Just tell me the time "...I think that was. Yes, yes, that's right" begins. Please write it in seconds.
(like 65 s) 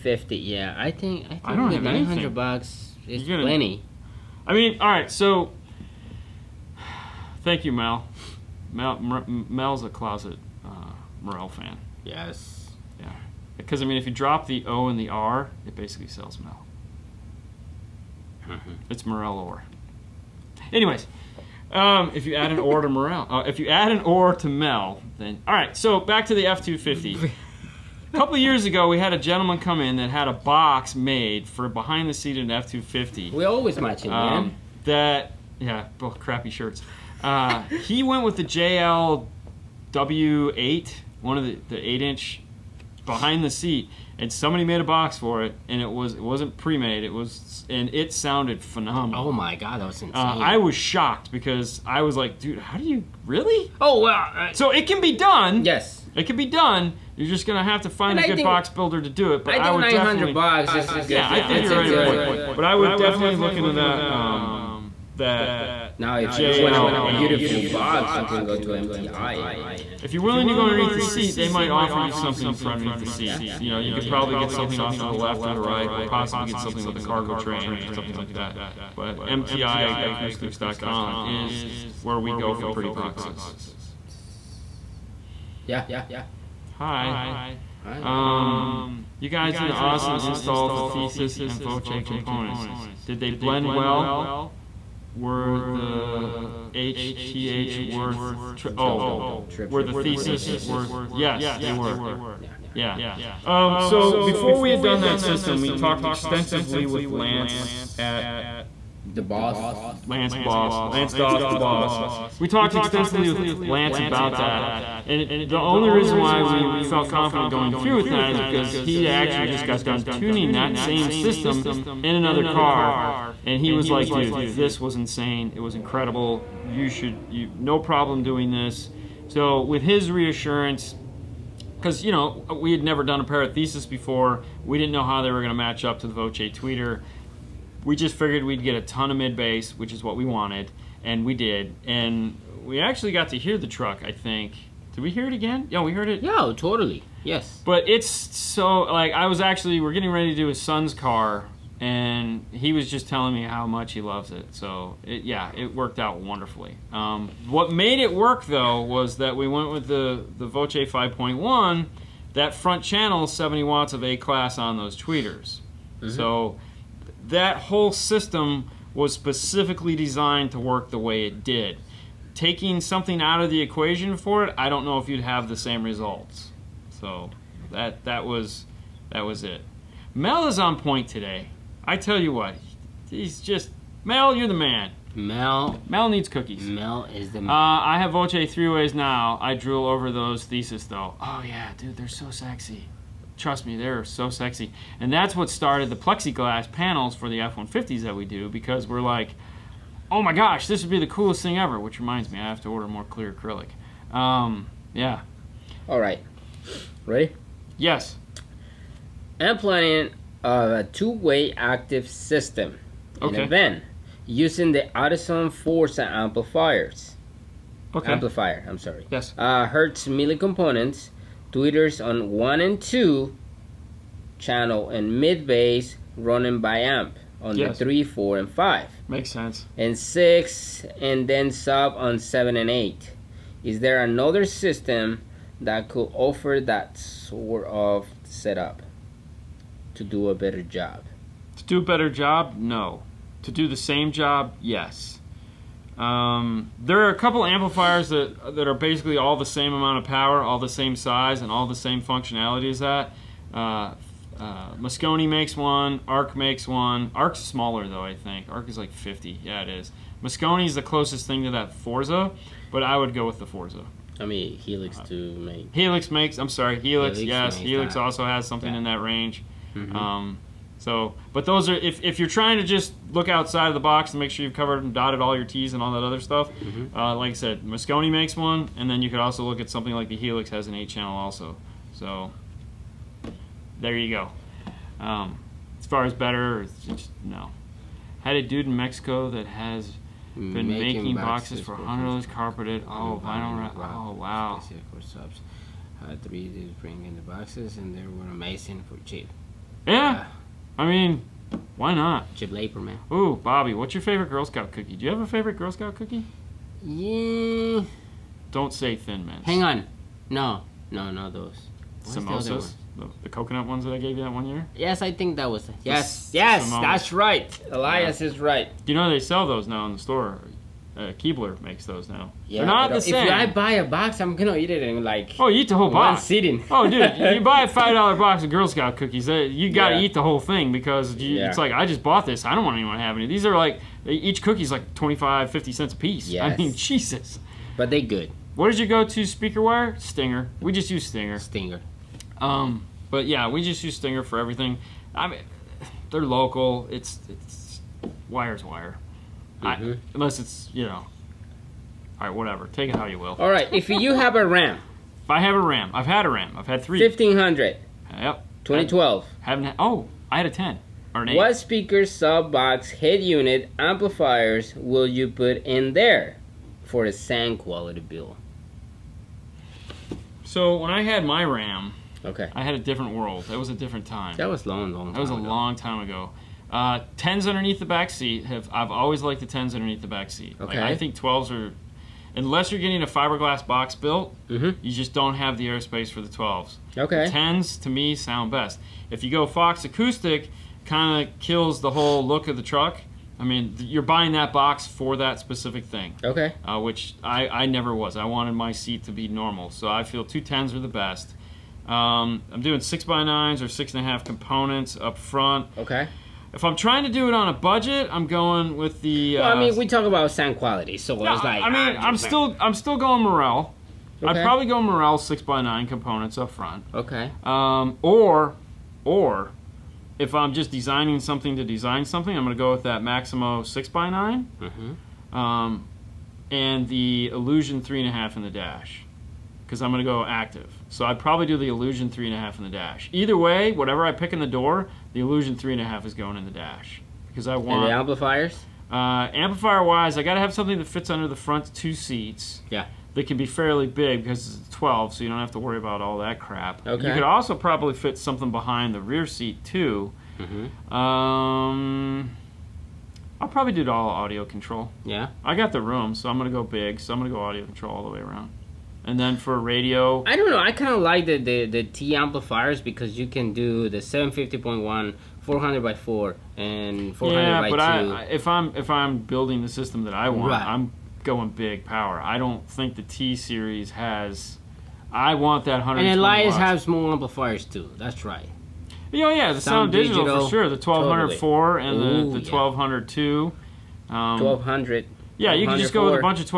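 315 s.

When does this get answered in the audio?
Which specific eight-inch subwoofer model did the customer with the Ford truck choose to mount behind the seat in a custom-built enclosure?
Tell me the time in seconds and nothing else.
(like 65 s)
38 s.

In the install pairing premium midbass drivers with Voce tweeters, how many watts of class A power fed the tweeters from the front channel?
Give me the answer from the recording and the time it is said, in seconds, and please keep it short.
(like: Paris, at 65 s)
70 watts, at 163 s.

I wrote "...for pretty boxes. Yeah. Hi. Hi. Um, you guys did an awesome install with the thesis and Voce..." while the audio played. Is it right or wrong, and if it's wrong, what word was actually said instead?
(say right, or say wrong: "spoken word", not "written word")
right.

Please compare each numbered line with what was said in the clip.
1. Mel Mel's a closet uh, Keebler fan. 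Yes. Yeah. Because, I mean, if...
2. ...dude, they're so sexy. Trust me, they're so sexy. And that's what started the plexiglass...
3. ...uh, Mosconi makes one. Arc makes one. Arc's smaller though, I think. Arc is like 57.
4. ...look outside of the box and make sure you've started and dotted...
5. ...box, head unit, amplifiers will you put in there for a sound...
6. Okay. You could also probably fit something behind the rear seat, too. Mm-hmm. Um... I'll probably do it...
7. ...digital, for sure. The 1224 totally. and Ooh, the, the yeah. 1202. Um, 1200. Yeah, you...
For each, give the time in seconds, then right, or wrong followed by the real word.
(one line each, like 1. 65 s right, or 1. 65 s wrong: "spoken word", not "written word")
1. 8 s wrong: "Morel", not "Keebler"
2. 191 s right
3. 254 s wrong: "50", not "57"
4. 273 s wrong: "covered", not "started"
5. 362 s right
6. 446 s right
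7. 480 s wrong: "1204", not "1224".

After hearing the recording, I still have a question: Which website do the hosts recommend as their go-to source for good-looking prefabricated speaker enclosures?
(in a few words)
MTIacoustics.com.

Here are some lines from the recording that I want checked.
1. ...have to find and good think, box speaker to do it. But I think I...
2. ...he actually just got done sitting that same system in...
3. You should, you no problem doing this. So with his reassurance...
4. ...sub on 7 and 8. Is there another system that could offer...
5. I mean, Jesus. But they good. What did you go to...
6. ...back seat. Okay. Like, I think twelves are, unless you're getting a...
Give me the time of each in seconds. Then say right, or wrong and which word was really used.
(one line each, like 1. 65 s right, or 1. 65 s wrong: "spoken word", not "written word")
1. 57 s wrong: "builder", not "speaker"
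2. 118 s wrong: "tuning", not "sitting"
3. 126 s right
4. 231 s right
5. 336 s right
6. 380 s right.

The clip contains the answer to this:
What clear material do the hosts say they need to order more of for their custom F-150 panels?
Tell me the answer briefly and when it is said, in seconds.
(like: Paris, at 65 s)
clear acrylic, at 203 s.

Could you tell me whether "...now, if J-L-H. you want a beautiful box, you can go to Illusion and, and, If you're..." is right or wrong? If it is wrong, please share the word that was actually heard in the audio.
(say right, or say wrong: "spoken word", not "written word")
wrong: "MTI", not "Illusion".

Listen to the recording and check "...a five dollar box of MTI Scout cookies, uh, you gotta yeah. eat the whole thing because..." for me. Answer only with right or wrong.
wrong.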